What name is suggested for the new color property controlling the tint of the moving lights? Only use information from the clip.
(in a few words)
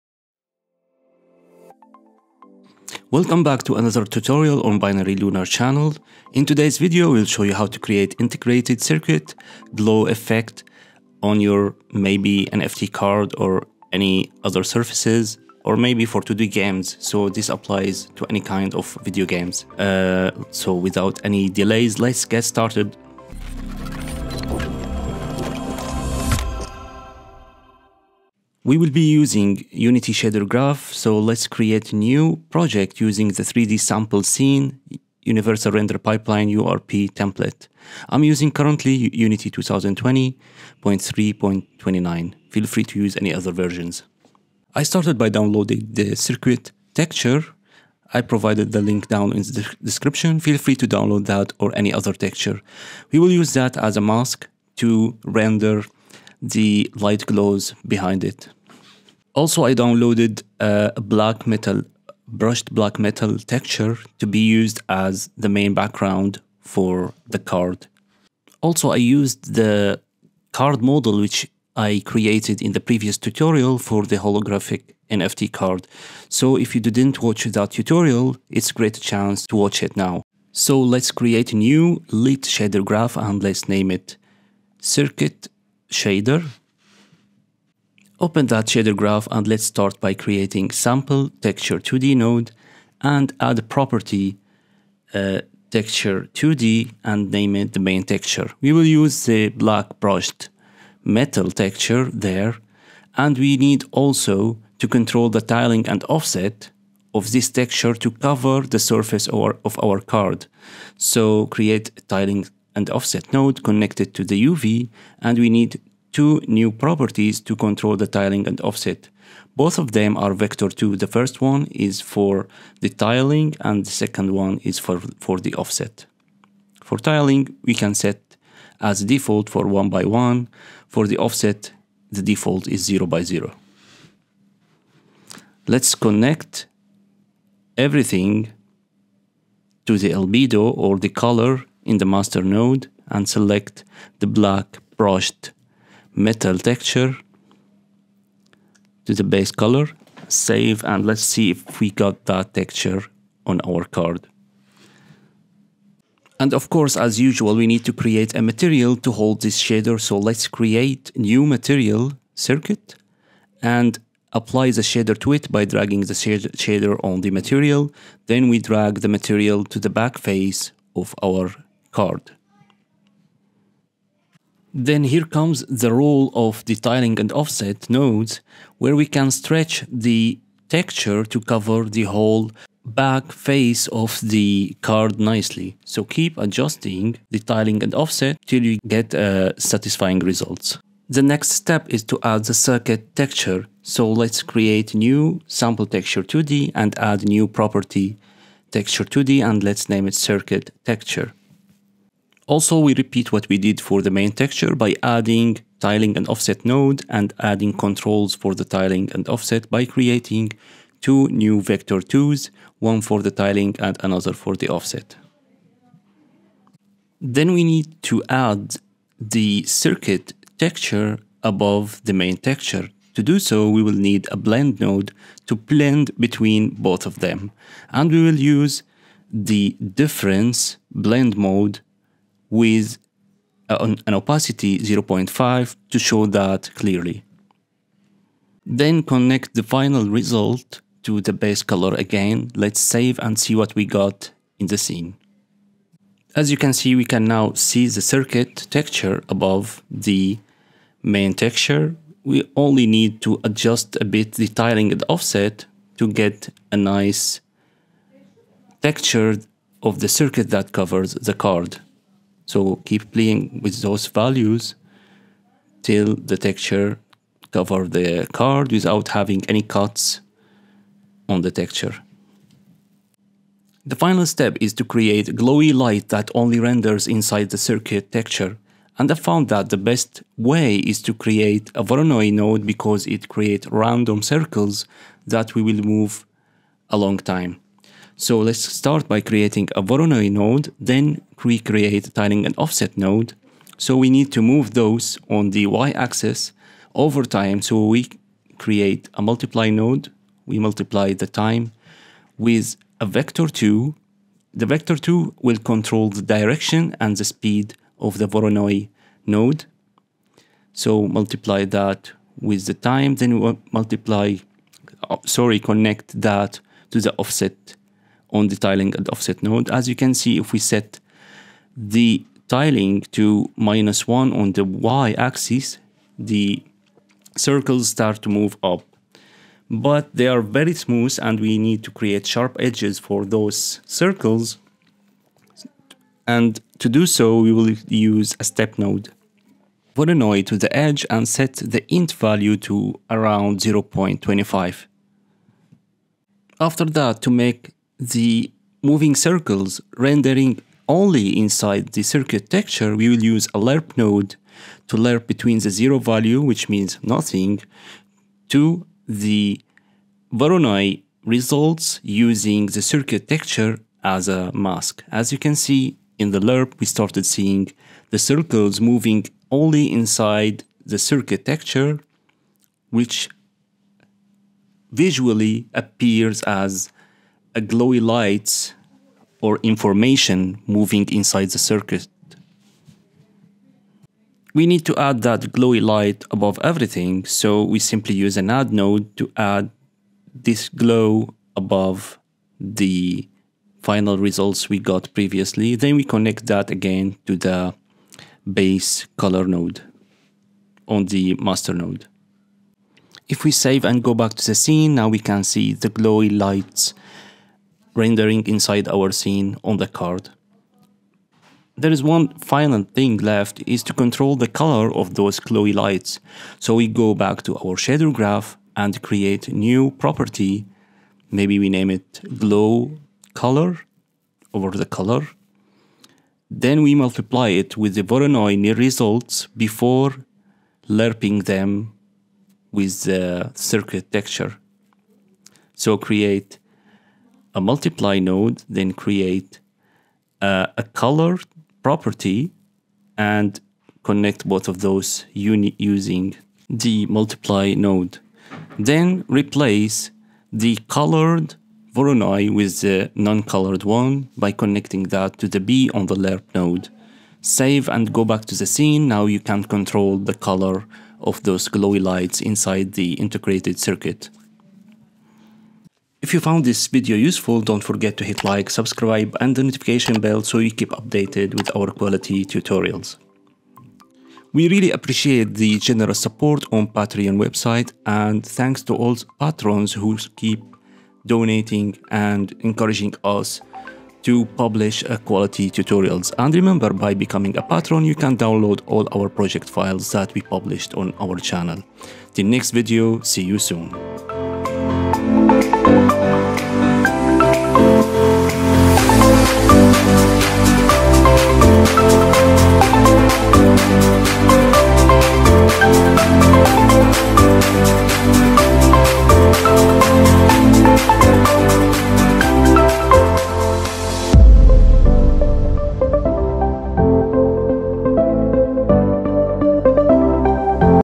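Glow color.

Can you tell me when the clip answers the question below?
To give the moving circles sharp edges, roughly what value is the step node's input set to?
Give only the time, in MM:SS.
05:43.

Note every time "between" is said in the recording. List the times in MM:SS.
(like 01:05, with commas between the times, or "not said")
03:46, 05:55.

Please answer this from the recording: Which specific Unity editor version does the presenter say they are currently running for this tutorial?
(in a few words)
2020.3.29.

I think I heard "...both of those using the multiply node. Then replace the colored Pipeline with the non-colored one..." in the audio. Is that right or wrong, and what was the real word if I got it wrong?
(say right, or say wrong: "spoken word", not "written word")
wrong: "Voronoi", not "Pipeline".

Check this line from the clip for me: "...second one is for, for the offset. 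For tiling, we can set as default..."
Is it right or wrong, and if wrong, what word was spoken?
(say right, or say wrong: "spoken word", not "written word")
right.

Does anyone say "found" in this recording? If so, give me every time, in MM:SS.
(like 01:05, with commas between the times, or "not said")
04:39, 07:46.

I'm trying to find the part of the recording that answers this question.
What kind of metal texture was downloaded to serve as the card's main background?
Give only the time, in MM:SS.
01:02.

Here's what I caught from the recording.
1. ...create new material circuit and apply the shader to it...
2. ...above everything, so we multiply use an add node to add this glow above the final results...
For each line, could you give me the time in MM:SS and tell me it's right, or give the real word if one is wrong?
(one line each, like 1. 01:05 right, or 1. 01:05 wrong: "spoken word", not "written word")
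1. 02:40 right
2. 06:26 wrong: "simply", not "multiply".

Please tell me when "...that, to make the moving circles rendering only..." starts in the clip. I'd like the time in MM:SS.
05:46.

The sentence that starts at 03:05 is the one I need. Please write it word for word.
So keep adjusting tiling and offset till you get uh, satisfying results.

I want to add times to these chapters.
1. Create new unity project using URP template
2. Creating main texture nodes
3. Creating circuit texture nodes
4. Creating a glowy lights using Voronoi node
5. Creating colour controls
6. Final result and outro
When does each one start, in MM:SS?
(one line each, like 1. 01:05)
1. 00:30
2. 01:25
3. 03:10
4. 04:35
5. 06:50
6. 07:47.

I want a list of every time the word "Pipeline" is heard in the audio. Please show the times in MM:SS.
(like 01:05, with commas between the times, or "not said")
00:35.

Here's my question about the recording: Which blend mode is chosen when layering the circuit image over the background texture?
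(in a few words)
Difference.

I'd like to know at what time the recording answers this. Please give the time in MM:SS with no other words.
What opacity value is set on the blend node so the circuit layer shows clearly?
03:54.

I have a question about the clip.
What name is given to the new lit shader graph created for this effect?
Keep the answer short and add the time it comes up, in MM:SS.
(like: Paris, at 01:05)
Circuit shader, at 01:24.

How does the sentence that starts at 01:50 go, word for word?
So create tiling and offset node connected to the UV, and we need two new properties to control the tiling and offset.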